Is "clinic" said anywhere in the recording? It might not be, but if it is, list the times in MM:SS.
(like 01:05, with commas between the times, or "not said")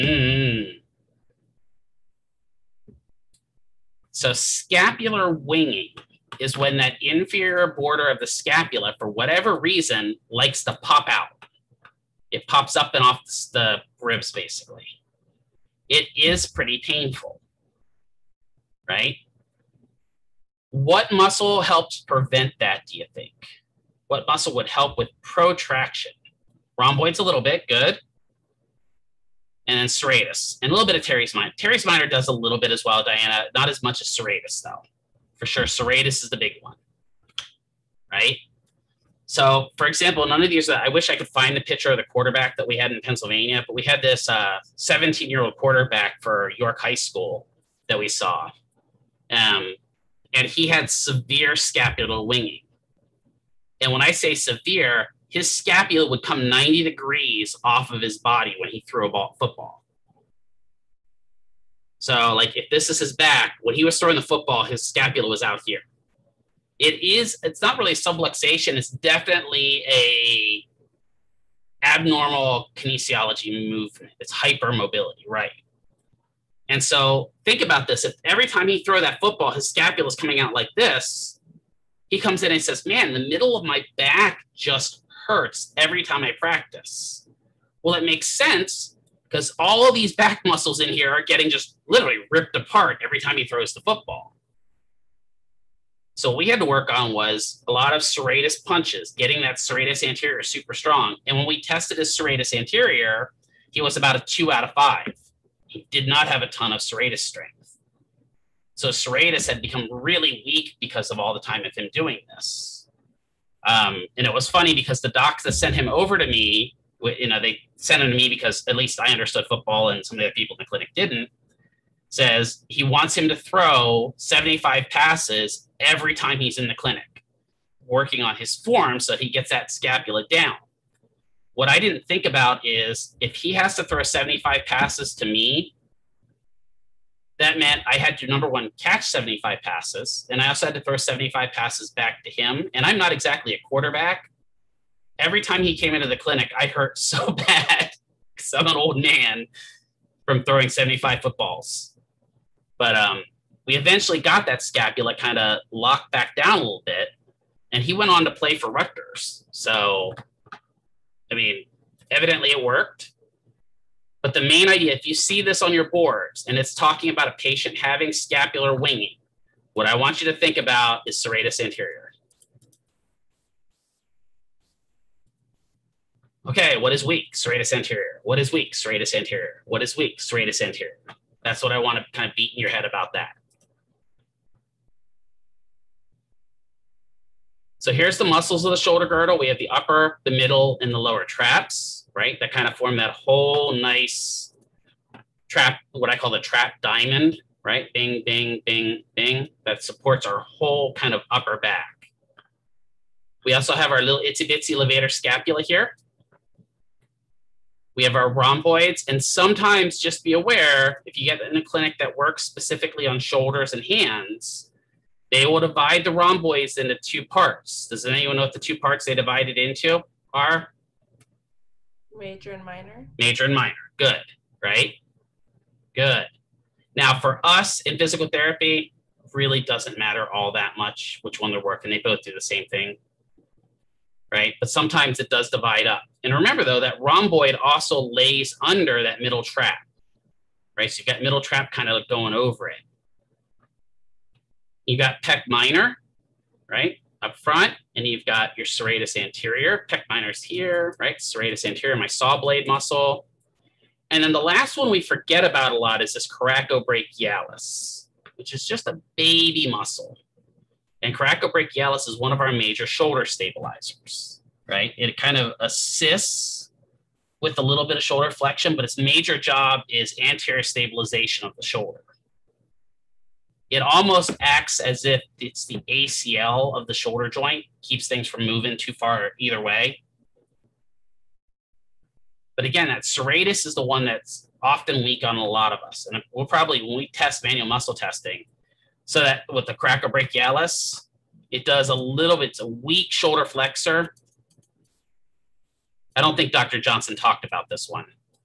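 02:00, 02:06, 02:26, 03:31.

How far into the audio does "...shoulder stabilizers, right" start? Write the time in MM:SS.
04:22.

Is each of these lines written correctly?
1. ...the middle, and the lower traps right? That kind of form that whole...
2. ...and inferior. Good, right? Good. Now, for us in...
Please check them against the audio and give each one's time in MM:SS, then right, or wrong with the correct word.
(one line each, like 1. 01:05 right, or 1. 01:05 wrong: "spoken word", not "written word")
1. 03:10 right
2. 03:43 wrong: "minor", not "inferior".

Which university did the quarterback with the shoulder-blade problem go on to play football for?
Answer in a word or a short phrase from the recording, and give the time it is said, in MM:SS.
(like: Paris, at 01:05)
Rutgers, at 02:38.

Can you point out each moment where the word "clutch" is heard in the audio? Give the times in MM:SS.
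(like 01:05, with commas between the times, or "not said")
not said.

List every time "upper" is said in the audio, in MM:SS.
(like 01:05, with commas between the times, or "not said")
03:09, 03:21.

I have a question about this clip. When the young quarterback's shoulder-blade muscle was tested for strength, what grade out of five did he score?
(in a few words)
2 out of 5.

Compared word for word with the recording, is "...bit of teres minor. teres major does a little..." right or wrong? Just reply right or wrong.
wrong.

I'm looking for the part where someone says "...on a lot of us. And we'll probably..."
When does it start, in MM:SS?
04:45.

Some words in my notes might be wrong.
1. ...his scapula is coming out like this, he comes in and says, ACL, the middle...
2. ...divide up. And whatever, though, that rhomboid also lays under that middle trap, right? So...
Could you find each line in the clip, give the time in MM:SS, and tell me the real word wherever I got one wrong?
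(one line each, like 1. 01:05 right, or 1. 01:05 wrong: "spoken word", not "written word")
1. 01:19 wrong: "Man", not "ACL"
2. 03:55 wrong: "remember", not "whatever".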